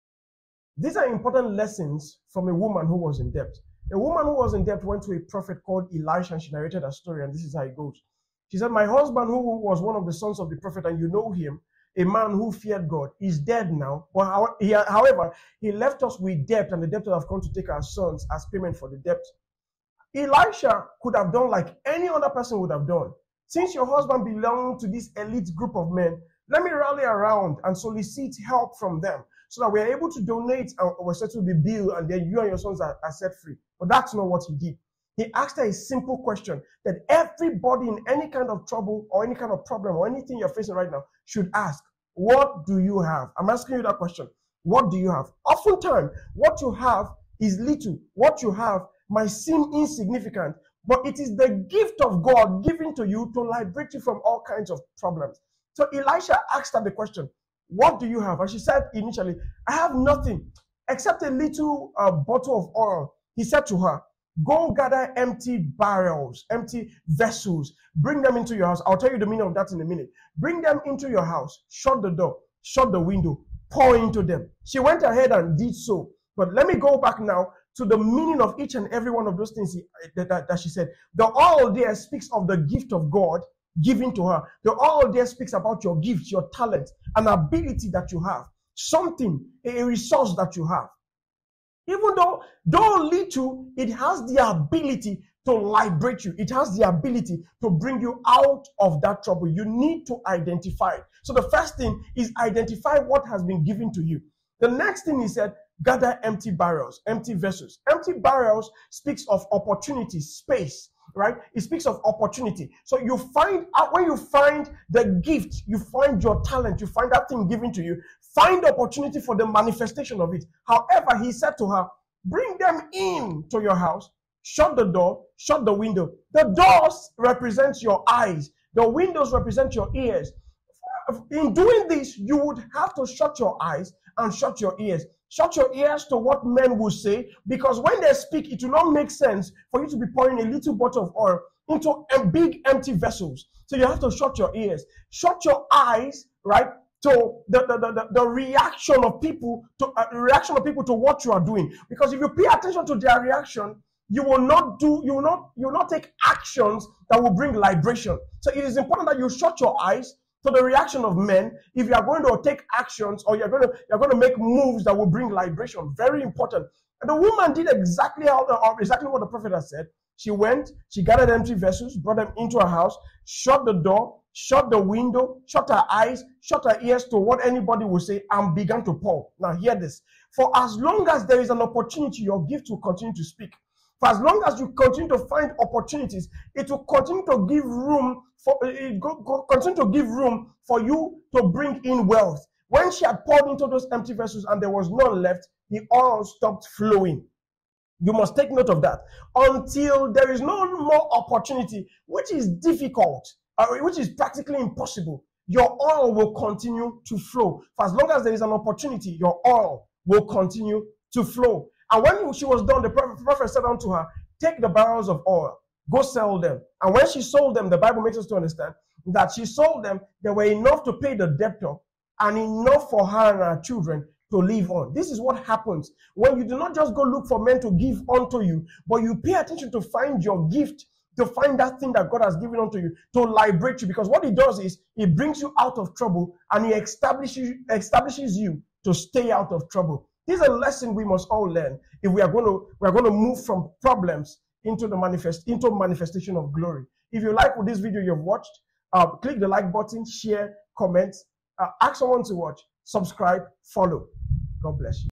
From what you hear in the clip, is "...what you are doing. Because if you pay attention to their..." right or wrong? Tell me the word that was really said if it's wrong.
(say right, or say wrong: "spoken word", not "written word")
right.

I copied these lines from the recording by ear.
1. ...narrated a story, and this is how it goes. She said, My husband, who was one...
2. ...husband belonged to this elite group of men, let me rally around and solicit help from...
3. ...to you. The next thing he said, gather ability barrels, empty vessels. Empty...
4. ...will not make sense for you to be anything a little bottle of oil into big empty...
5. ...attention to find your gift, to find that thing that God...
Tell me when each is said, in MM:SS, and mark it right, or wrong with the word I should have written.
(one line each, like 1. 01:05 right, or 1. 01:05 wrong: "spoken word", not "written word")
1. 00:06 right
2. 00:23 right
3. 01:43 wrong: "empty", not "ability"
4. 02:18 wrong: "pouring", not "anything"
5. 03:49 right.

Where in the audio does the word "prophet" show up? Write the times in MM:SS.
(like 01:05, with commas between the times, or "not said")
00:05, 00:10, 02:49, 03:32.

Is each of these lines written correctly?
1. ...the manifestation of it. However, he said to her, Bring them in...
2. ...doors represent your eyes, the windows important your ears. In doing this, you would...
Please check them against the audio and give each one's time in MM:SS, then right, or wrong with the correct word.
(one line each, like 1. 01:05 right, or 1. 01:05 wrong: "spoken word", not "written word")
1. 01:59 right
2. 02:06 wrong: "represent", not "important".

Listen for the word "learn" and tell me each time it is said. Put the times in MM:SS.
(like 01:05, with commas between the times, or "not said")
04:01.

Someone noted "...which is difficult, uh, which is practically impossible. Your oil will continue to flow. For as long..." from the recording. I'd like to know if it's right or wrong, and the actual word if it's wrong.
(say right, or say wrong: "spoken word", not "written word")
right.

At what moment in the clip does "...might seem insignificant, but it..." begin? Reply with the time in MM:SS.
00:49.